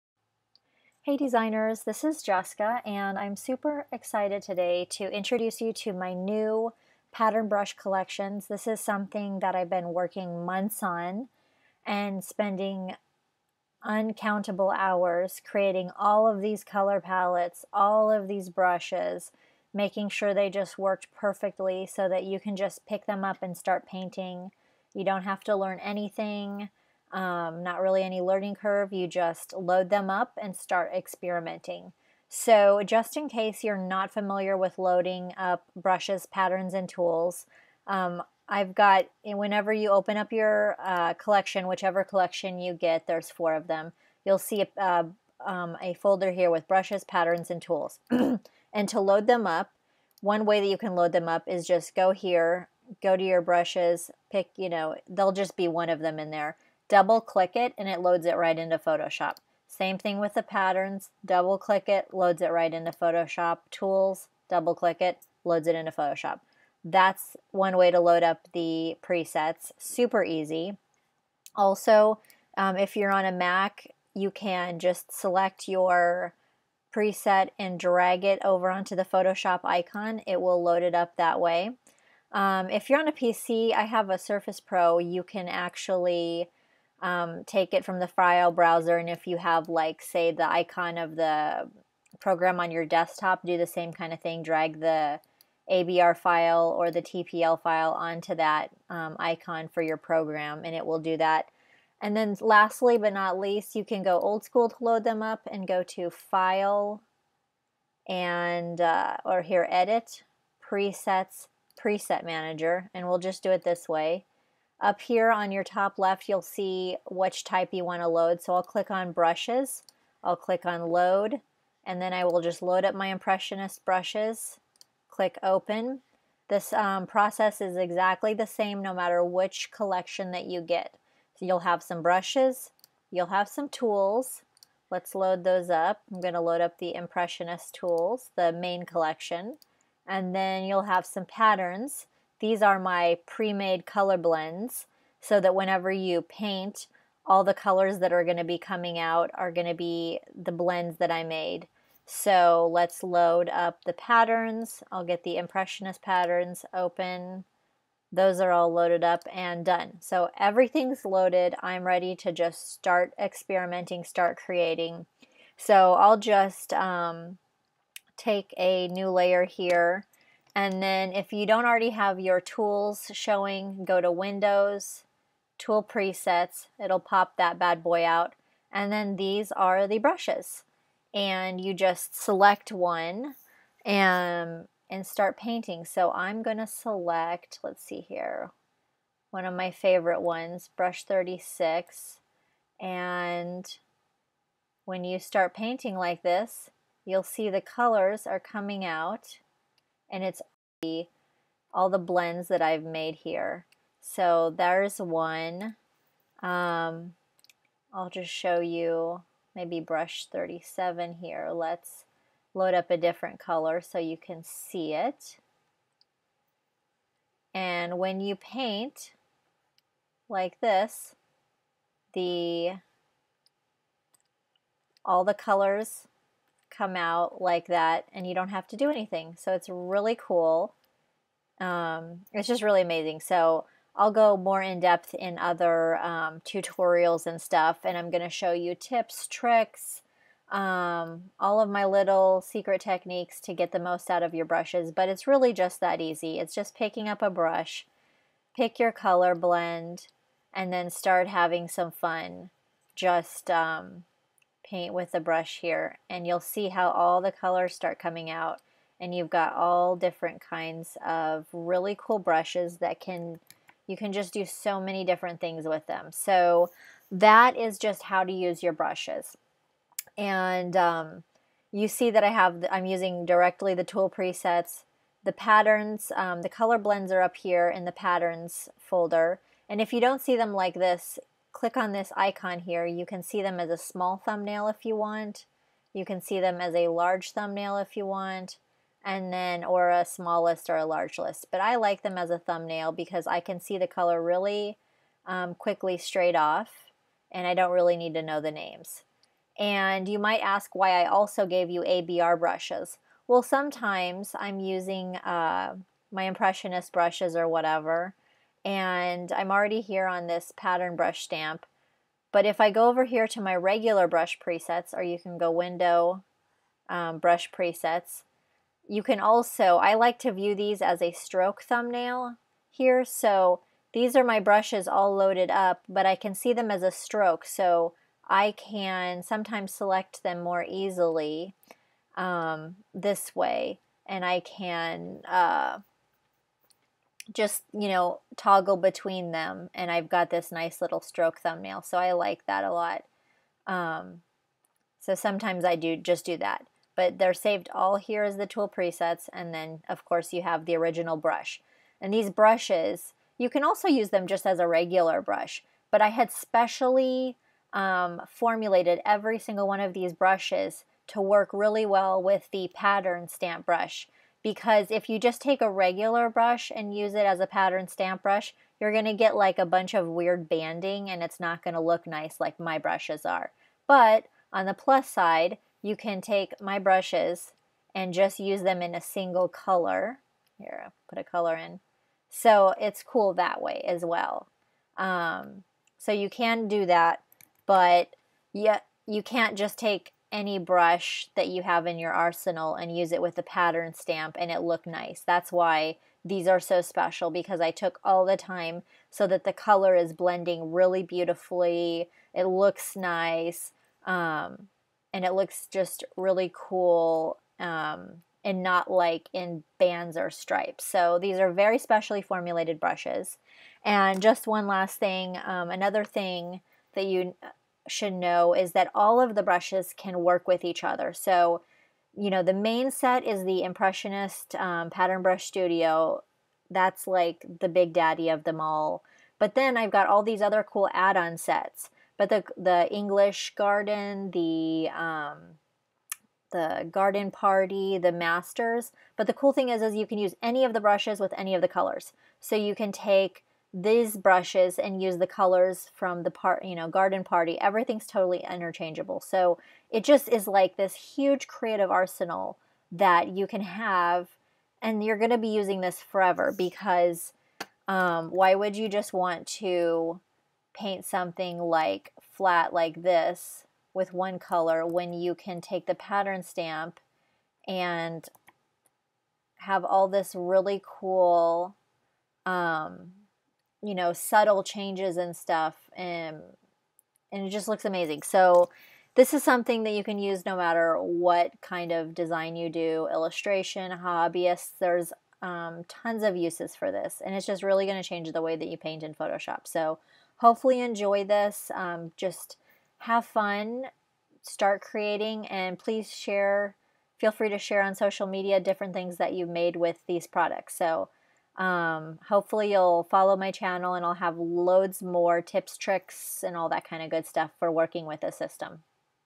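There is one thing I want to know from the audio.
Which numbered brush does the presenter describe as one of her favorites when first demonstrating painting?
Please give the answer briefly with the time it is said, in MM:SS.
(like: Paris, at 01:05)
36, at 03:10.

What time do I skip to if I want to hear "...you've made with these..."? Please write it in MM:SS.
08:19.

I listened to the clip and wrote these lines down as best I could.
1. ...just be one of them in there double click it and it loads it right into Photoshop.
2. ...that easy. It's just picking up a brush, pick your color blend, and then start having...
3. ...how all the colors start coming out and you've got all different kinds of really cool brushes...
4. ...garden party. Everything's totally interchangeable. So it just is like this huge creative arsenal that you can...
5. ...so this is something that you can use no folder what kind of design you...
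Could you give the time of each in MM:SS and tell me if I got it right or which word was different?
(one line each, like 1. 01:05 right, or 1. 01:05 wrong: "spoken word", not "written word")
1. 00:55 right
2. 04:05 right
3. 04:16 right
4. 07:26 right
5. 07:58 wrong: "matter", not "folder".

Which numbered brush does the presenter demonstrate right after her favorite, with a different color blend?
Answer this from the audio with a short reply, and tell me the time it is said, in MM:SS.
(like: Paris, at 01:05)
37, at 03:29.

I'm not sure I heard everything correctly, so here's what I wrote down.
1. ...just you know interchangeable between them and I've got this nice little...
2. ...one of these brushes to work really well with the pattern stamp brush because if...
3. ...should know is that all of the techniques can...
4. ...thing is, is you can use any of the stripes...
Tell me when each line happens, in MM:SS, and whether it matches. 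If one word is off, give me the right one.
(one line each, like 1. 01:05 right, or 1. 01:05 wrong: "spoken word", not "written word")
1. 05:37 wrong: "toggle", not "interchangeable"
2. 05:59 right
3. 06:57 wrong: "brushes", not "techniques"
4. 07:19 wrong: "brushes", not "stripes".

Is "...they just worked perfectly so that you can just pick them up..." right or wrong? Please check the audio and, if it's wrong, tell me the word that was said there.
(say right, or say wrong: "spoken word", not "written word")
right.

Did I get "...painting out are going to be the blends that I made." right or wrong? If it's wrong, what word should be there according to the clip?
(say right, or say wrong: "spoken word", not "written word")
wrong: "coming", not "painting".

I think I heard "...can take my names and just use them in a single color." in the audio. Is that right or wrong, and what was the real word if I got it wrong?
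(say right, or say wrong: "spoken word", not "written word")
wrong: "brushes", not "names".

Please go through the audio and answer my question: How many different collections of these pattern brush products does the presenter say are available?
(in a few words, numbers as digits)
4.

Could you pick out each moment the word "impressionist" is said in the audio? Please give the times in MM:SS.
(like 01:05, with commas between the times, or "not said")
02:03, 02:16, 02:35, 05:06, 07:03.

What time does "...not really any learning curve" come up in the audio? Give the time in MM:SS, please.
00:27.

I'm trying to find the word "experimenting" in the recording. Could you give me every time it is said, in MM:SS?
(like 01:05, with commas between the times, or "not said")
00:30, 02:43.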